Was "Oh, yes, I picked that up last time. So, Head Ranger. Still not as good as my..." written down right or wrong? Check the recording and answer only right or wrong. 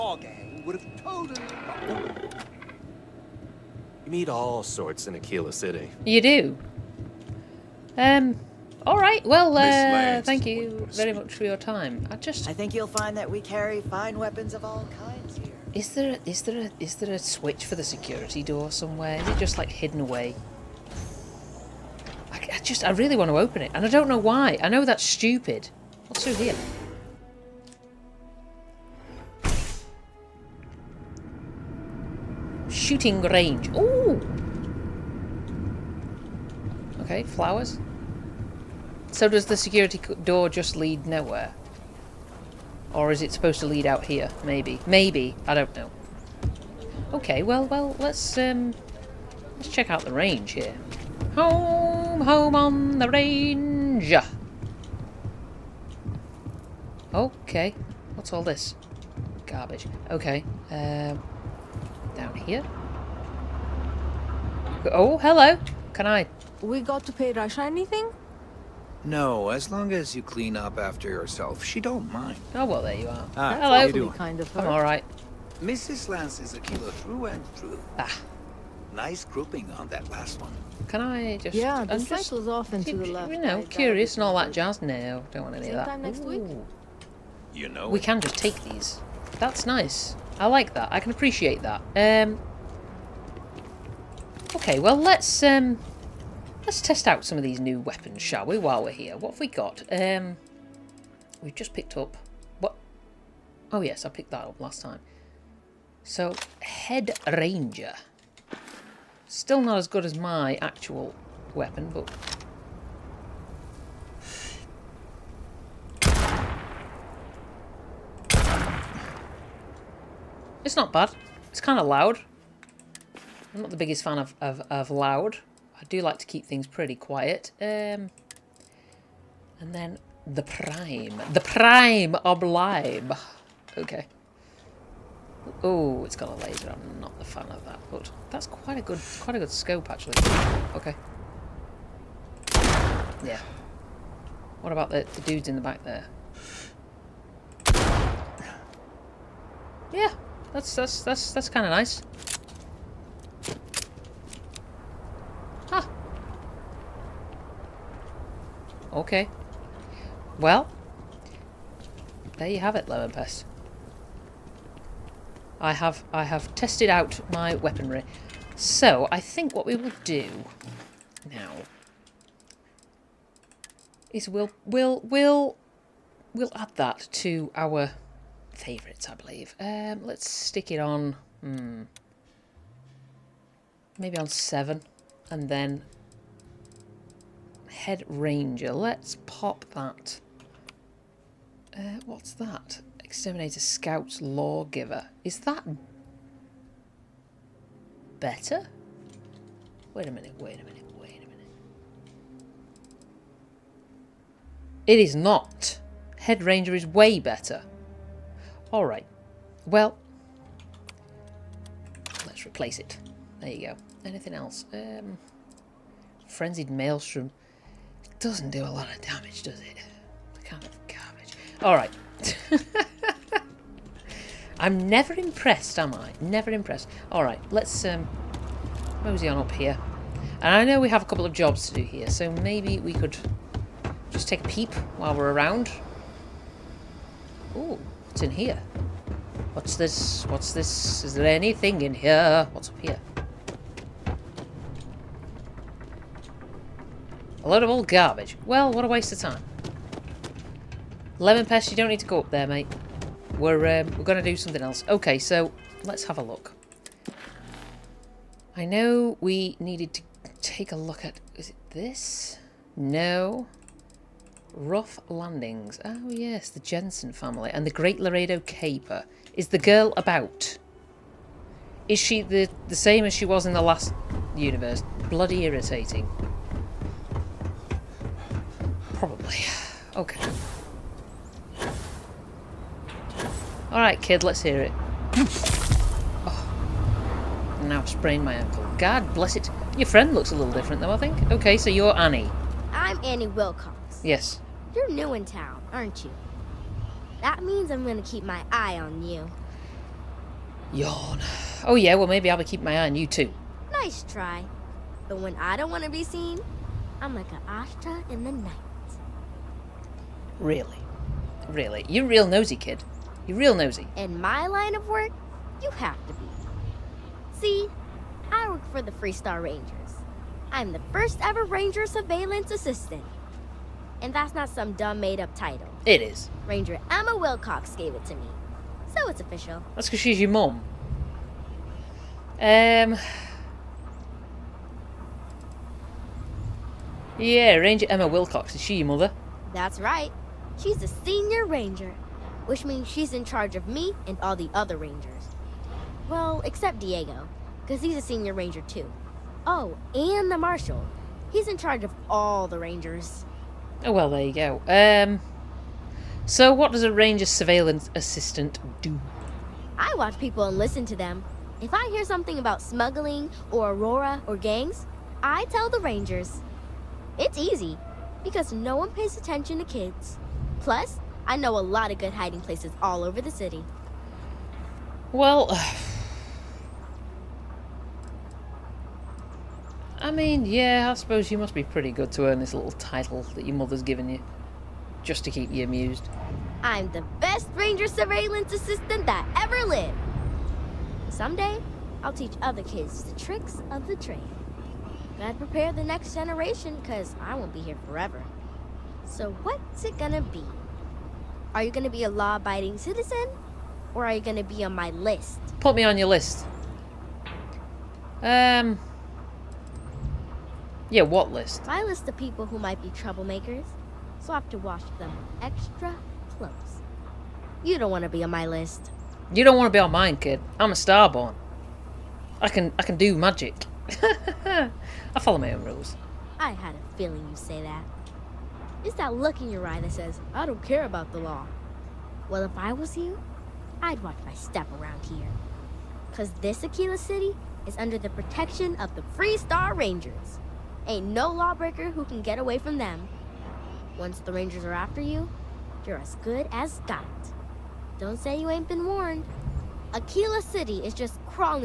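right.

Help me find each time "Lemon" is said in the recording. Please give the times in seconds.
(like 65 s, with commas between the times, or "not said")
162 s, 251 s.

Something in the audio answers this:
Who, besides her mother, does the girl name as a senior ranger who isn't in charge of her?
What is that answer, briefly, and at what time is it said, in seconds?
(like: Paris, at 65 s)
Diego, at 346 s.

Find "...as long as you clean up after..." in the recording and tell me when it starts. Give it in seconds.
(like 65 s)
69 s.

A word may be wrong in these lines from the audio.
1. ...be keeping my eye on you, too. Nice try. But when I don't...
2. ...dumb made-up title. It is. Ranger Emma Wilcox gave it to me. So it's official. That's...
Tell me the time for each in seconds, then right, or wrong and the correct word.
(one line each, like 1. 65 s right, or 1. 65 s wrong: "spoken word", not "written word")
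1. 302 s right
2. 324 s right.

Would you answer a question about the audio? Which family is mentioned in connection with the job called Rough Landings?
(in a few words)
Jensen family.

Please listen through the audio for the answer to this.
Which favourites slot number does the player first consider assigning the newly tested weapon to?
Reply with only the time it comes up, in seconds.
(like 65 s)
184 s.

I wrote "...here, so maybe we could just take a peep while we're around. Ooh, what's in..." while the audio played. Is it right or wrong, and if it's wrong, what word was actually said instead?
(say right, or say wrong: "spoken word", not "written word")
right.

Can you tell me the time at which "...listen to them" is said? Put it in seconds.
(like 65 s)
360 s.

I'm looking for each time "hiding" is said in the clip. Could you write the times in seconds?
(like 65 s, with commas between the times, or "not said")
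372 s.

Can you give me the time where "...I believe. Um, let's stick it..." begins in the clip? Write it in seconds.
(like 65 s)
179 s.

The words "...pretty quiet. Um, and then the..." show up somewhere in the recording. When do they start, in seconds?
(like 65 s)
126 s.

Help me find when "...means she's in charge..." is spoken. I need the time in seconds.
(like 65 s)
342 s.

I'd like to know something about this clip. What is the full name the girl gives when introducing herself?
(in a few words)
Annie Wilcox.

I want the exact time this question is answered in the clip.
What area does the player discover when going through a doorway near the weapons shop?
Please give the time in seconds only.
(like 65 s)
32 s.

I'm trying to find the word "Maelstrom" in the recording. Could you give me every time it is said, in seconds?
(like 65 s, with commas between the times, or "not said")
216 s.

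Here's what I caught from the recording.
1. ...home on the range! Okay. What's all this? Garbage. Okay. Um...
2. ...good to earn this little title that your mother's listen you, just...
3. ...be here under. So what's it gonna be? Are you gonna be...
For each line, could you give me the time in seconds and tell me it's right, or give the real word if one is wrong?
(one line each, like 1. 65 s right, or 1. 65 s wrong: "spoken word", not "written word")
1. 52 s right
2. 381 s wrong: "given", not "listen"
3. 397 s wrong: "forever", not "under".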